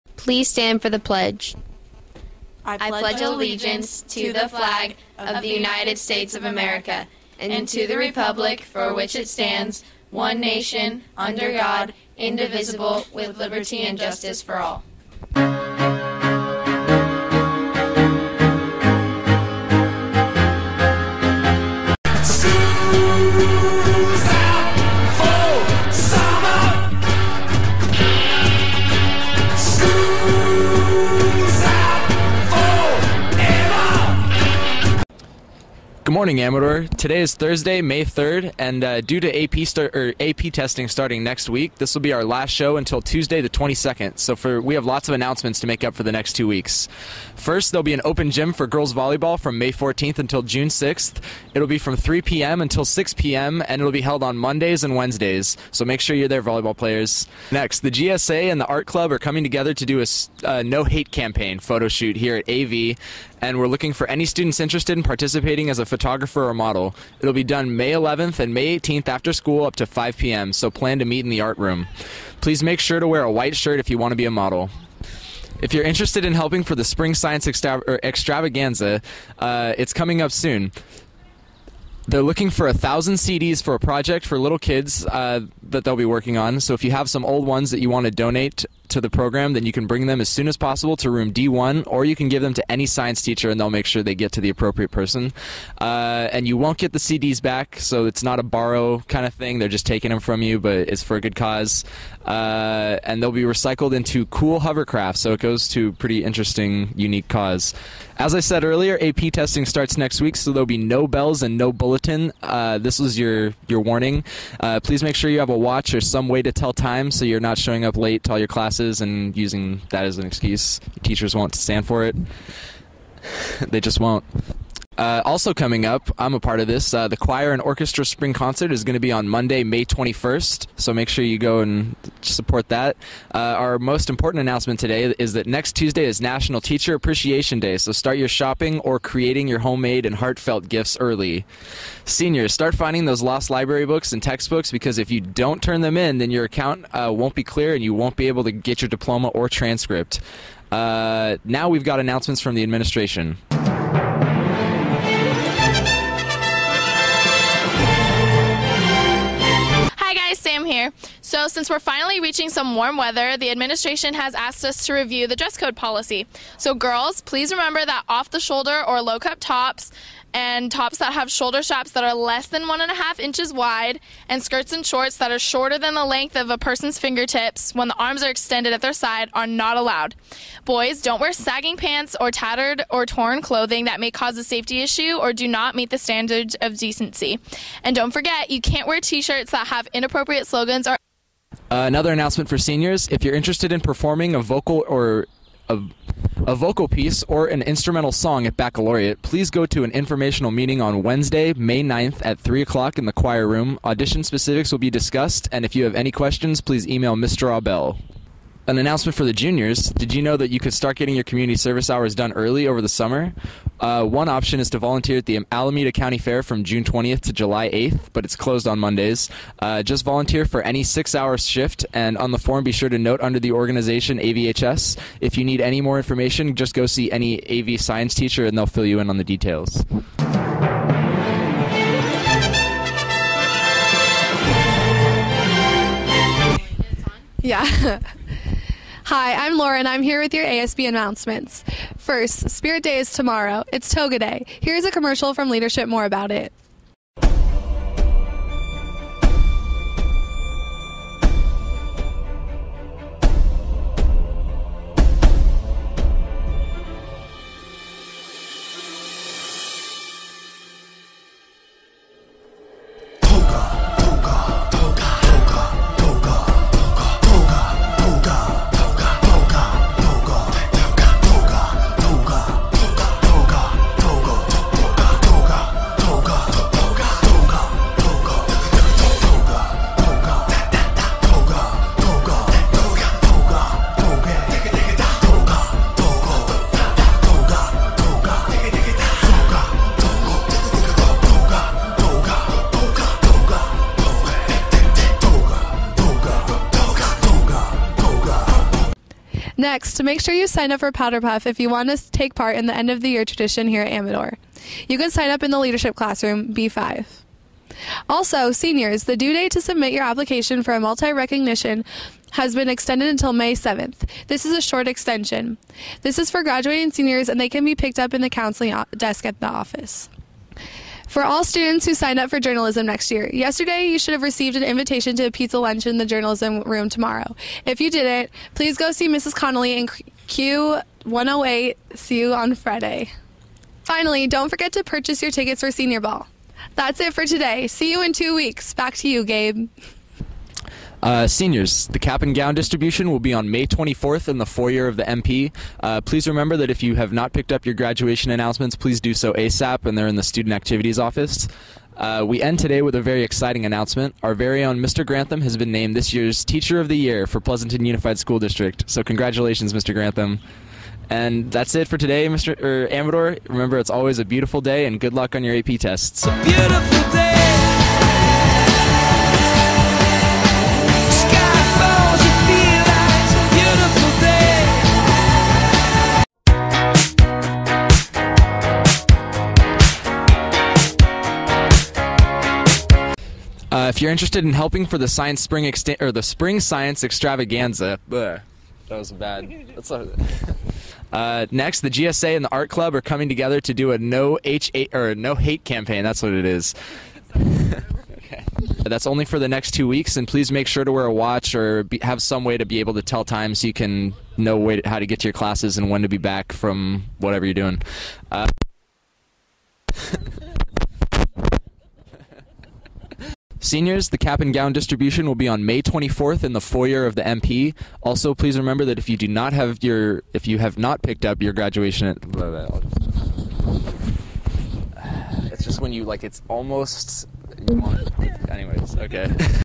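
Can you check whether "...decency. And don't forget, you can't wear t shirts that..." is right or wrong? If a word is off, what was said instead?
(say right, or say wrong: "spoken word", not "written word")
right.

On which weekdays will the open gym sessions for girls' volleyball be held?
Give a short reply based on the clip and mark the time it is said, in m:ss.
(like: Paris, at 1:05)
Mondays and Wednesdays, at 0:54.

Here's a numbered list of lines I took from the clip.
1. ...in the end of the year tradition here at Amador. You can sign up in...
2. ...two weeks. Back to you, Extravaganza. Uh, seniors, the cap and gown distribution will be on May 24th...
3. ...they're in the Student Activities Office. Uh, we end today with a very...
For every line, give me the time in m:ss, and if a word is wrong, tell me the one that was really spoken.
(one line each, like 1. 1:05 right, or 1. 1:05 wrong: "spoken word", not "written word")
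1. 5:02 right
2. 5:38 wrong: "Gabe", not "Extravaganza"
3. 5:49 right.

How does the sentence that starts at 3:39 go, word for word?
Uh, just volunteer for any six hour shift, and on the form, be sure to note under the organization AVHS.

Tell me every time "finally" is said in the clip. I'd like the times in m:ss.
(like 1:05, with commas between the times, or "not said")
2:41, 5:33.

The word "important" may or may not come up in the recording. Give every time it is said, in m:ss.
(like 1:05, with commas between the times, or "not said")
2:14.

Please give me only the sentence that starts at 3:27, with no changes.
Abell an announcement for the juniors.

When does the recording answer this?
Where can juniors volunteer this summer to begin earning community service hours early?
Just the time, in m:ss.
3:35.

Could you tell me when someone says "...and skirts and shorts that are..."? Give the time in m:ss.
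2:54.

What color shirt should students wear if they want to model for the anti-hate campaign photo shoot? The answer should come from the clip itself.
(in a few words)
White.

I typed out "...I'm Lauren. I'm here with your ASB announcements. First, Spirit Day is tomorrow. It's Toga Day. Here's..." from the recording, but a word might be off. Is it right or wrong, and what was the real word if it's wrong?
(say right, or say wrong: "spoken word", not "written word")
right.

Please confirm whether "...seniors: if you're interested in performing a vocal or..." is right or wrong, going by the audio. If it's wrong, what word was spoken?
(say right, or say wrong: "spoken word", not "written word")
right.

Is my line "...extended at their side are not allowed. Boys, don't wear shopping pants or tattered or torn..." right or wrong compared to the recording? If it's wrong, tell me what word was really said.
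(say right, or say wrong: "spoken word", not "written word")
wrong: "sagging", not "shopping".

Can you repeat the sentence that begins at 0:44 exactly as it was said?
So for we have lots of announcements to make up for the next two weeks.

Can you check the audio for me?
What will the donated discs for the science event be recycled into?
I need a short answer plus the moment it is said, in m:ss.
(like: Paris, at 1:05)
Hovercraft, at 1:44.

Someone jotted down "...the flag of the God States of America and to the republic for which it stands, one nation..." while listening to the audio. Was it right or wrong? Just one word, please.
wrong.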